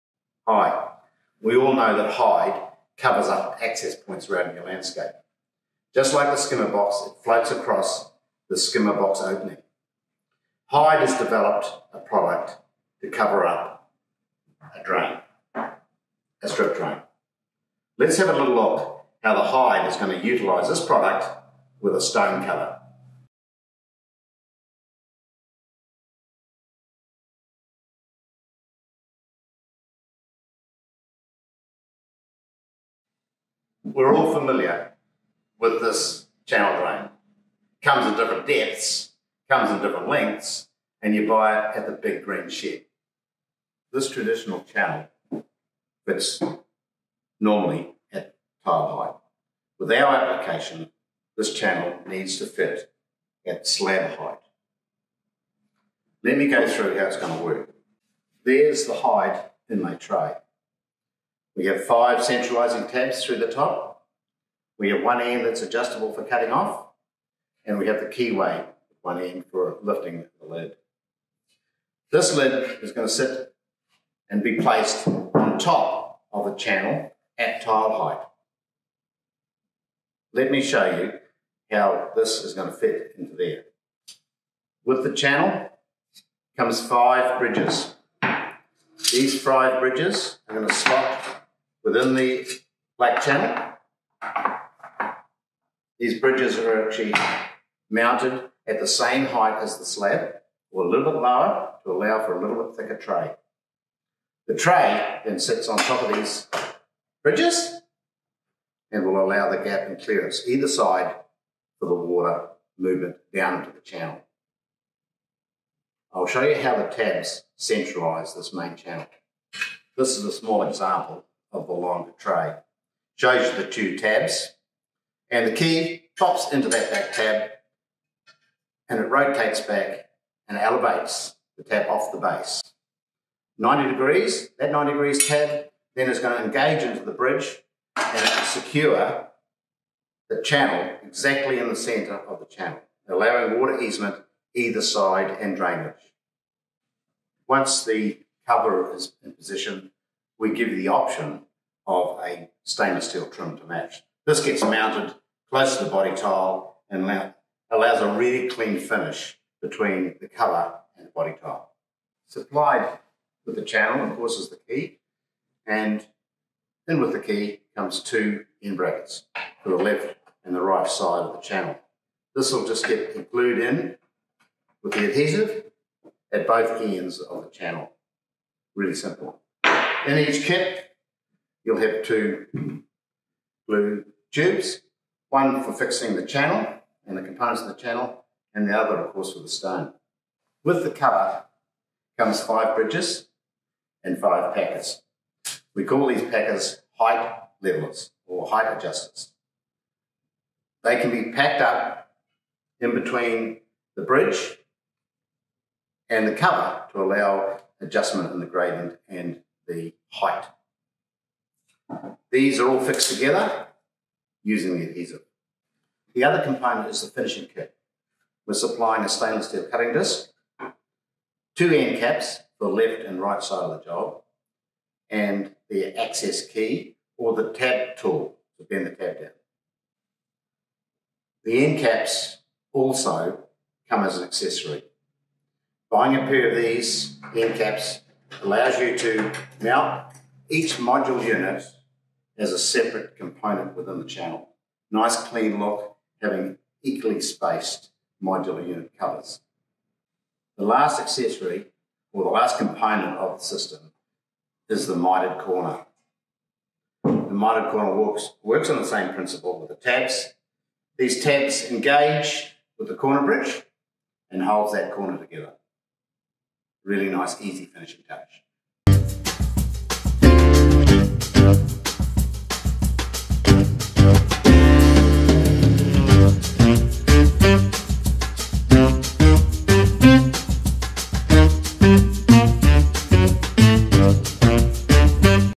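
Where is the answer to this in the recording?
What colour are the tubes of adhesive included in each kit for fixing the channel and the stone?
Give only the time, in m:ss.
3:03.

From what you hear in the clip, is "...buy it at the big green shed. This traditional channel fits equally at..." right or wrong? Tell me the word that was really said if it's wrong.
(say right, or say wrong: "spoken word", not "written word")
wrong: "normally", not "equally".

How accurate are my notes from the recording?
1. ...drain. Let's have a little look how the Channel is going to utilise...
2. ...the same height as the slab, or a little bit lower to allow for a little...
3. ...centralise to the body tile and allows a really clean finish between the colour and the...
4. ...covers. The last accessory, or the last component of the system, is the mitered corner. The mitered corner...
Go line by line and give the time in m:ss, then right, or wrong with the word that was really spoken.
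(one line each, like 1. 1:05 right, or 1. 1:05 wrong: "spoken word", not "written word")
1. 0:16 wrong: "HIDE", not "Channel"
2. 1:38 right
3. 2:35 wrong: "close", not "centralise"
4. 4:08 right.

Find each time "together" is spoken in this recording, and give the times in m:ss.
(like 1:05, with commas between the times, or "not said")
3:33, 4:25.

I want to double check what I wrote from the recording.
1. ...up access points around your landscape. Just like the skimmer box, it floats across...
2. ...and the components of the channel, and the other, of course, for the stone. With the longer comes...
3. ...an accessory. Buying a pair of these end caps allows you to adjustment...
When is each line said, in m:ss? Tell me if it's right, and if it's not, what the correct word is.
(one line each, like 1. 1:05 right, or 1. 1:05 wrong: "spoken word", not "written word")
1. 0:03 right
2. 3:07 wrong: "cover", not "longer"
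3. 3:54 wrong: "mount", not "adjustment".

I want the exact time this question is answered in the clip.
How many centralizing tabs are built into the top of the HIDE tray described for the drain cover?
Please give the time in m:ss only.
1:01.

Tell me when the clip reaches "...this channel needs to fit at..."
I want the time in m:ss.
0:51.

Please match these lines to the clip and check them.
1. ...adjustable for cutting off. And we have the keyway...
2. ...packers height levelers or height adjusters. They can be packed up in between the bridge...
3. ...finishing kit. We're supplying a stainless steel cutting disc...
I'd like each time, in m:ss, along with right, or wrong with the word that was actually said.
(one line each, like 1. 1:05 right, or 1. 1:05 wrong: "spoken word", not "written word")
1. 1:05 right
2. 3:16 right
3. 3:37 right.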